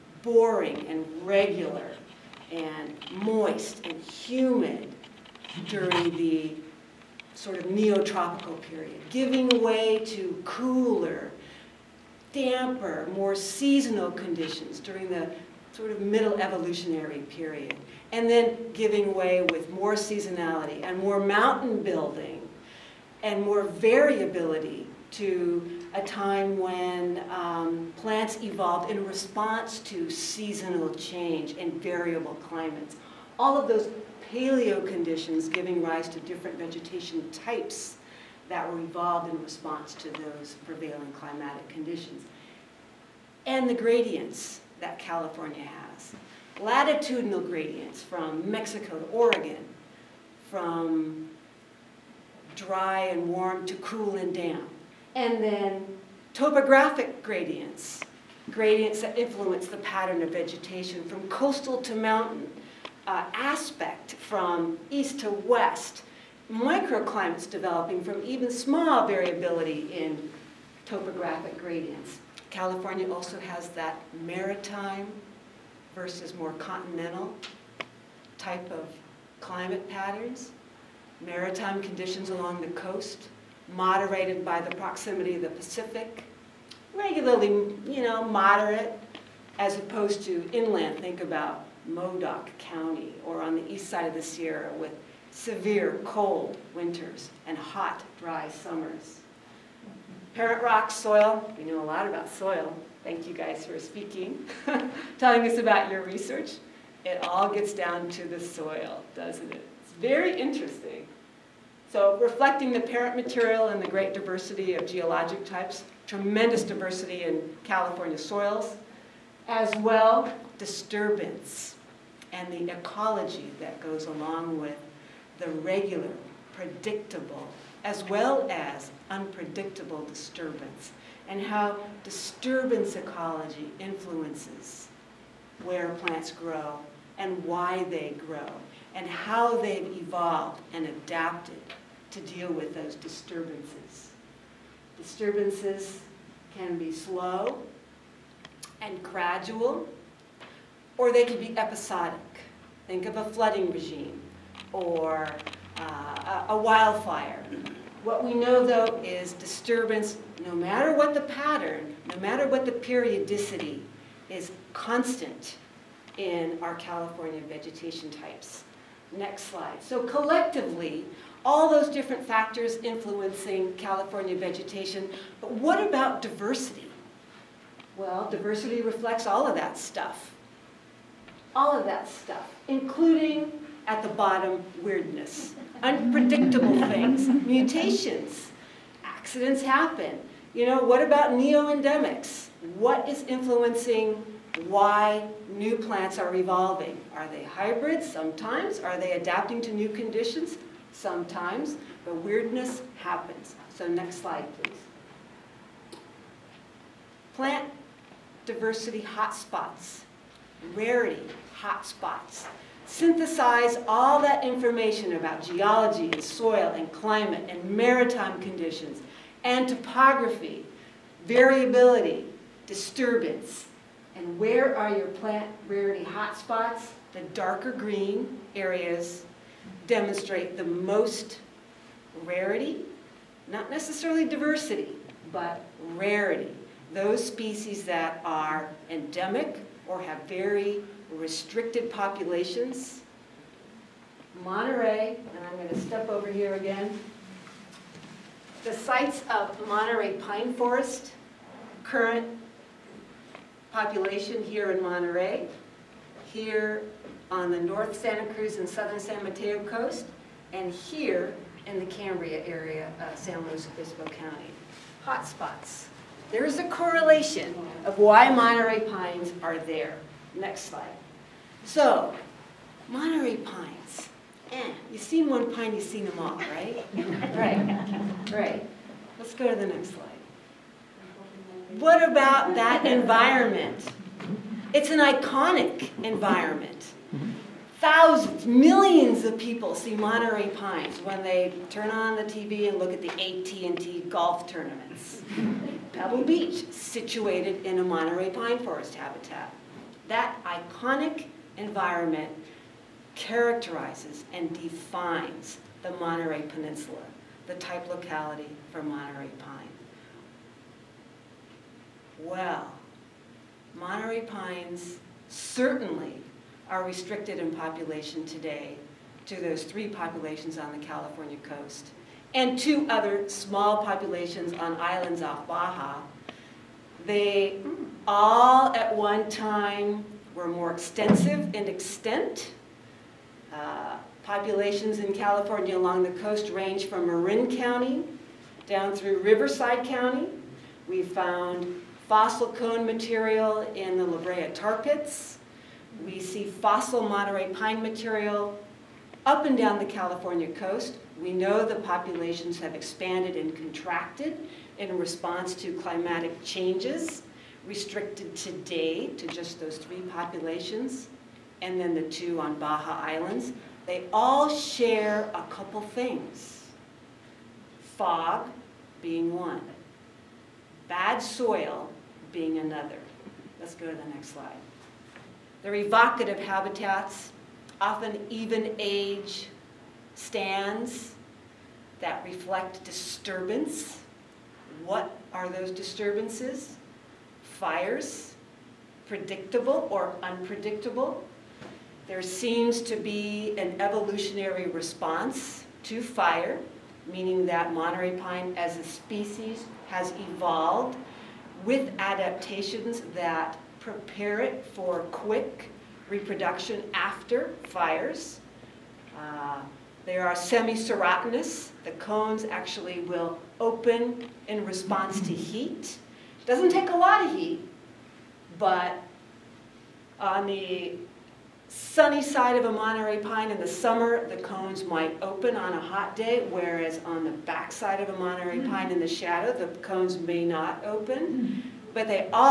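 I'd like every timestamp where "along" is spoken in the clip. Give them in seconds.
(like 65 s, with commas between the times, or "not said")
82 s, 124 s, 335 s.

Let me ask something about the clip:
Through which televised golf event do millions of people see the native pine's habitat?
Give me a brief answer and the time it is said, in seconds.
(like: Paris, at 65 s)
AT&T golf tournaments, at 293 s.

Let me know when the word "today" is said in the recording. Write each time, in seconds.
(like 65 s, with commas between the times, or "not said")
318 s, 358 s.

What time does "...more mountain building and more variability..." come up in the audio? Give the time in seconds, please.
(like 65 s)
20 s.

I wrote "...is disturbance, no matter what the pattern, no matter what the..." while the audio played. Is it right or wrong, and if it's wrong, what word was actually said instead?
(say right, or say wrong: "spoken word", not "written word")
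right.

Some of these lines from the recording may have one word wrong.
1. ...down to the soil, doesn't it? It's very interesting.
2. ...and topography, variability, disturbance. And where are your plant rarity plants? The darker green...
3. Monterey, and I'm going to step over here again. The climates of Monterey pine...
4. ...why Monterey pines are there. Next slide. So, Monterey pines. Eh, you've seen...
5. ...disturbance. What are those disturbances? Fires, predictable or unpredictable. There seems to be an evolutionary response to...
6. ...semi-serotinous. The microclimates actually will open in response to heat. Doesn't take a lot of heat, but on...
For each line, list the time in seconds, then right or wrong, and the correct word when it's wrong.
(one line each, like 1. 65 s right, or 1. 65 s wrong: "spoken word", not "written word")
1. 107 s right
2. 219 s wrong: "hotspots", not "plants"
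3. 244 s wrong: "sites", not "climates"
4. 267 s right
5. 382 s right
6. 410 s wrong: "cones", not "microclimates".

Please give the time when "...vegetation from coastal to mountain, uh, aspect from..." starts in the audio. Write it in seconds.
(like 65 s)
60 s.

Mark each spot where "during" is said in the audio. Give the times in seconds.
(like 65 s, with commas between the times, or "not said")
5 s, 14 s.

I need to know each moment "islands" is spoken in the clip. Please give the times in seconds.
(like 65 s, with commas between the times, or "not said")
324 s, 363 s.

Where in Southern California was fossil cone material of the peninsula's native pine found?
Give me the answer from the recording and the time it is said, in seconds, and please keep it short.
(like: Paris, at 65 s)
La Brea tar pits, at 344 s.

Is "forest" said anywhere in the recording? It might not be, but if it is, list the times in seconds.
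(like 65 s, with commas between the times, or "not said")
250 s, 298 s.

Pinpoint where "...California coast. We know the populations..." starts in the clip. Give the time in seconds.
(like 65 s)
349 s.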